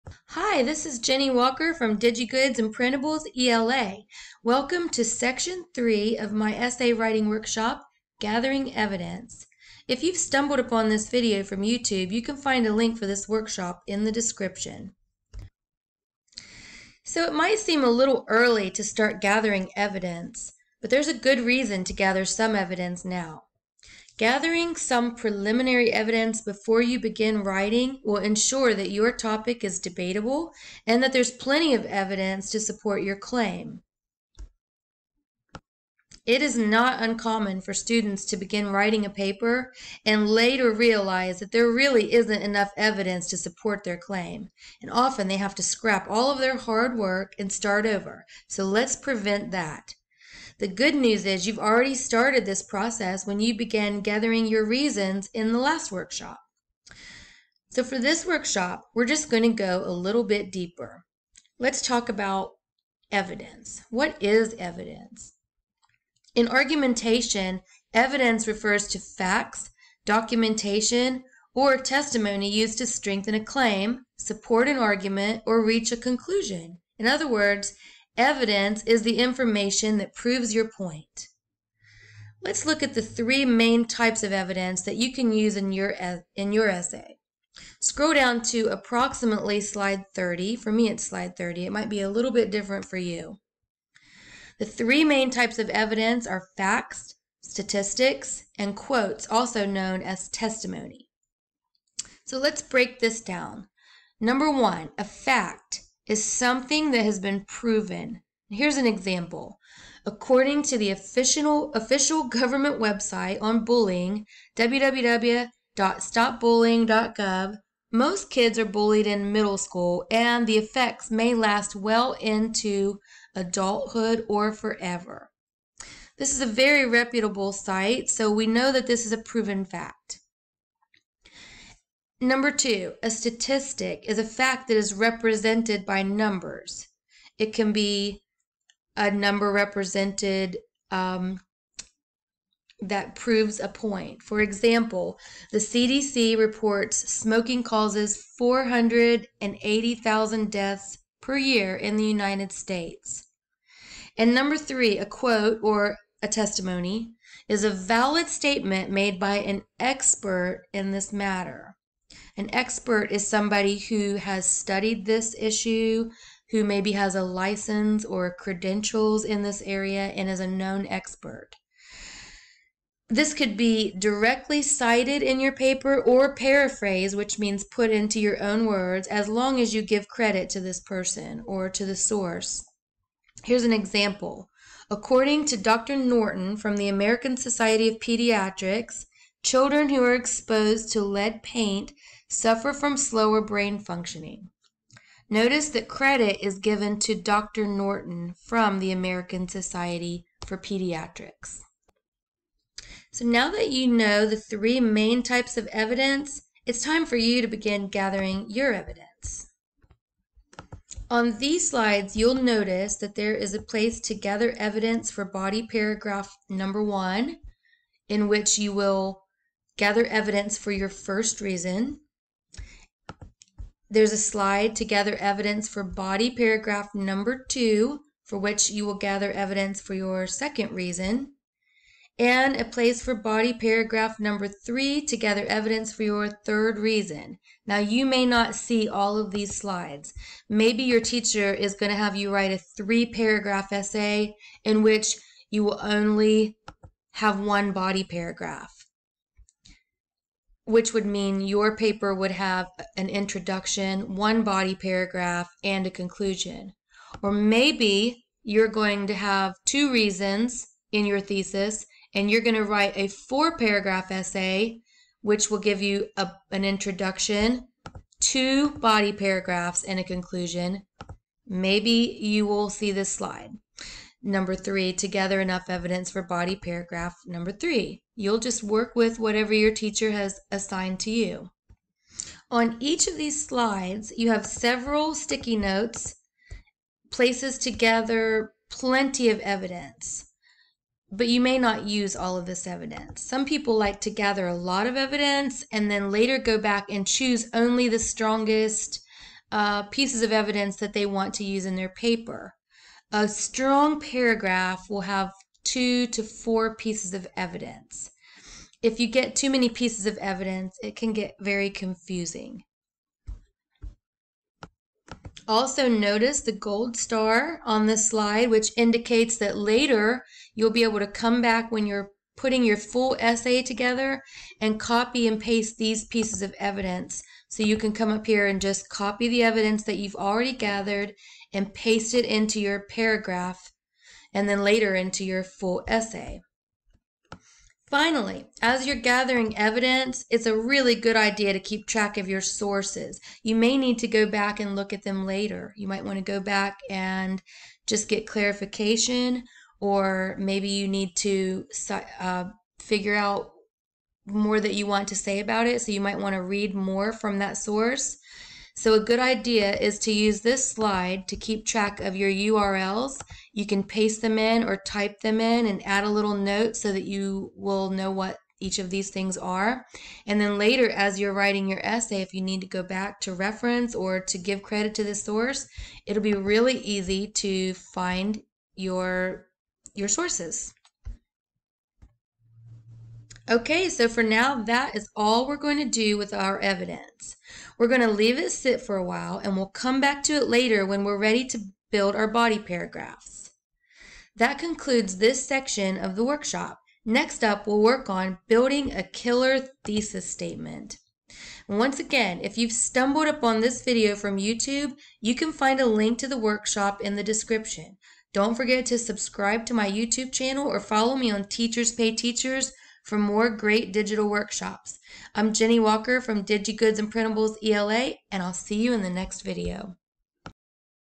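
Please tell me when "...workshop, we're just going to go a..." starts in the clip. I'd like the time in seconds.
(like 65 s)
58 s.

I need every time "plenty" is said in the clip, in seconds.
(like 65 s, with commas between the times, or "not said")
31 s, 288 s.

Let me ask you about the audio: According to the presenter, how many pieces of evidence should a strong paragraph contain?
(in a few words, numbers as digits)
2 to 4.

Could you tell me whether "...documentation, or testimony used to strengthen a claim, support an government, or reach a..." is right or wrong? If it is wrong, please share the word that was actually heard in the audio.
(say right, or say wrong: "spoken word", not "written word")
wrong: "argument", not "government".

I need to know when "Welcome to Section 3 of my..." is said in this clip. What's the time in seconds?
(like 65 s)
4 s.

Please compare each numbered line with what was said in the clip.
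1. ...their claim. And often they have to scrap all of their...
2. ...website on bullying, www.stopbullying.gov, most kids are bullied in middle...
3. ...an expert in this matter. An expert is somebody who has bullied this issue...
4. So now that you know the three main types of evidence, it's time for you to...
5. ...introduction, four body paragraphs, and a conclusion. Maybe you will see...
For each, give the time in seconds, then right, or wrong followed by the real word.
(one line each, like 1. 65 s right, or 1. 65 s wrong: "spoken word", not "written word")
1. 43 s right
2. 112 s right
3. 159 s wrong: "studied", not "bullied"
4. 203 s right
5. 266 s wrong: "two", not "four".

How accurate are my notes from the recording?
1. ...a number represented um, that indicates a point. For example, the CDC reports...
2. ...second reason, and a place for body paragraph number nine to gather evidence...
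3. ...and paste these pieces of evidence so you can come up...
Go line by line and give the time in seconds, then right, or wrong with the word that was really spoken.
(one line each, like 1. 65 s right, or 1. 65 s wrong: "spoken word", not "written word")
1. 138 s wrong: "proves", not "indicates"
2. 230 s wrong: "three", not "nine"
3. 325 s right.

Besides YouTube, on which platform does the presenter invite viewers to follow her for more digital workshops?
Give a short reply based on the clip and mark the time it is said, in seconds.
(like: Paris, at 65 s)
Teachers Pay Teachers, at 411 s.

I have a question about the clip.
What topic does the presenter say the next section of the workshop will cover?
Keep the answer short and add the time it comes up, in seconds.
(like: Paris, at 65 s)
thesis statement, at 399 s.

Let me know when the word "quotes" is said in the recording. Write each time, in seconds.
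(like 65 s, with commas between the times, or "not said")
98 s, 155 s.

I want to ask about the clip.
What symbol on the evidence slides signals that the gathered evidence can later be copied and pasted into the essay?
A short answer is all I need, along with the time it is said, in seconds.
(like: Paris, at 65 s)
gold star, at 316 s.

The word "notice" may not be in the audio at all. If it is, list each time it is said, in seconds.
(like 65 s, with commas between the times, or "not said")
195 s, 212 s, 315 s.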